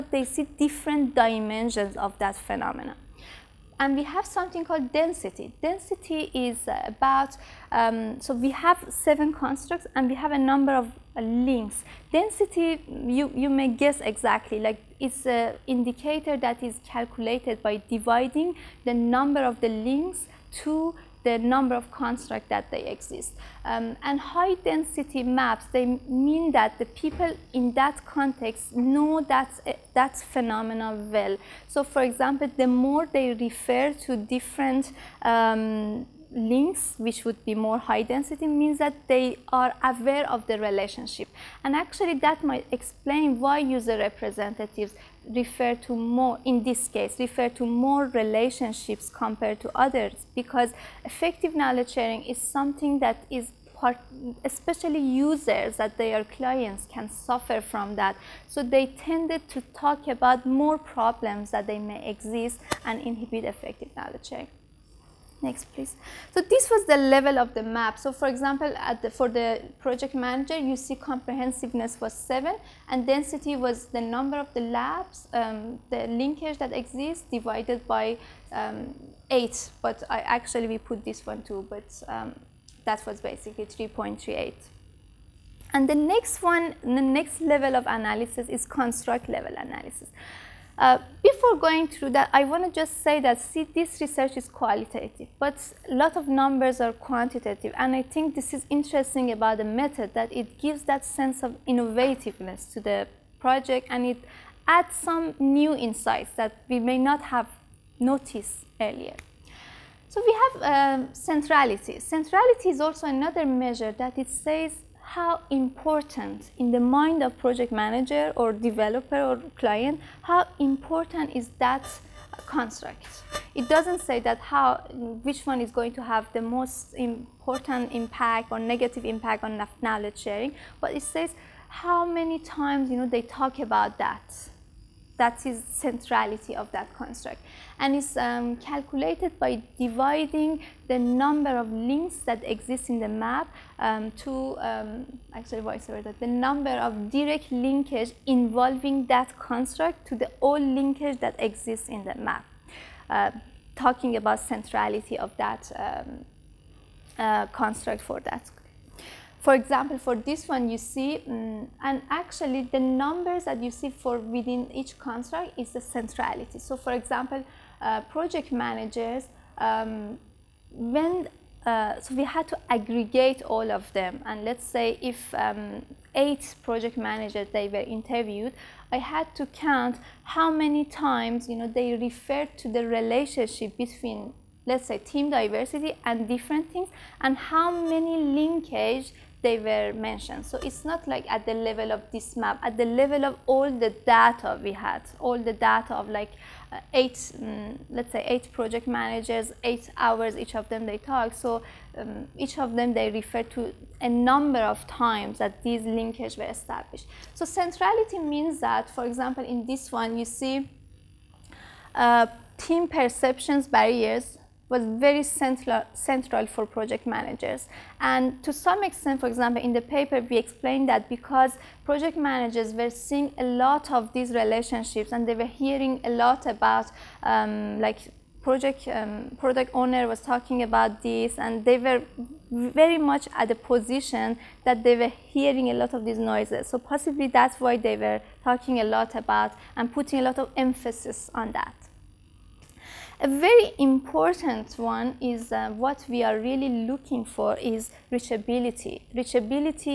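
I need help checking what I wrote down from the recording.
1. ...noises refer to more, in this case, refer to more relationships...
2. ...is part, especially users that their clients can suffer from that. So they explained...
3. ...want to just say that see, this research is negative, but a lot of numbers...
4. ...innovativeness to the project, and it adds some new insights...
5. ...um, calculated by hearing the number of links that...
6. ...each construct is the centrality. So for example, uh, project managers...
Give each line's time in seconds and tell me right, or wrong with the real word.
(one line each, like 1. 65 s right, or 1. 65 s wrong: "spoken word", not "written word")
1. 43 s wrong: "representatives", not "noises"
2. 53 s wrong: "tended", not "explained"
3. 92 s wrong: "qualitative", not "negative"
4. 101 s right
5. 138 s wrong: "dividing", not "hearing"
6. 164 s right.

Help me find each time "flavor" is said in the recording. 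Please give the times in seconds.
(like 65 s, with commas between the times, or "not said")
not said.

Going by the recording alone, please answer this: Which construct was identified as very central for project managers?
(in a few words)
Team perceptions barriers.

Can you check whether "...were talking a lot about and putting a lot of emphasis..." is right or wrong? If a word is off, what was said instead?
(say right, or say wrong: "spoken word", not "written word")
right.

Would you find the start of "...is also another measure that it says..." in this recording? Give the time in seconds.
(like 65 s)
112 s.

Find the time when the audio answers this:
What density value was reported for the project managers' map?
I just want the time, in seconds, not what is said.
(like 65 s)
83 s.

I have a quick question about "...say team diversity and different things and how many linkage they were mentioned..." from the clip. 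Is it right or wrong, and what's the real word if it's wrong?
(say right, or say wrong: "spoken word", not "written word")
right.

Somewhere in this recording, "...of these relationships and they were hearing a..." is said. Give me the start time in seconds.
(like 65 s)
223 s.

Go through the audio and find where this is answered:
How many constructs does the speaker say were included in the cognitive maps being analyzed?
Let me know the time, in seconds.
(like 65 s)
8 s.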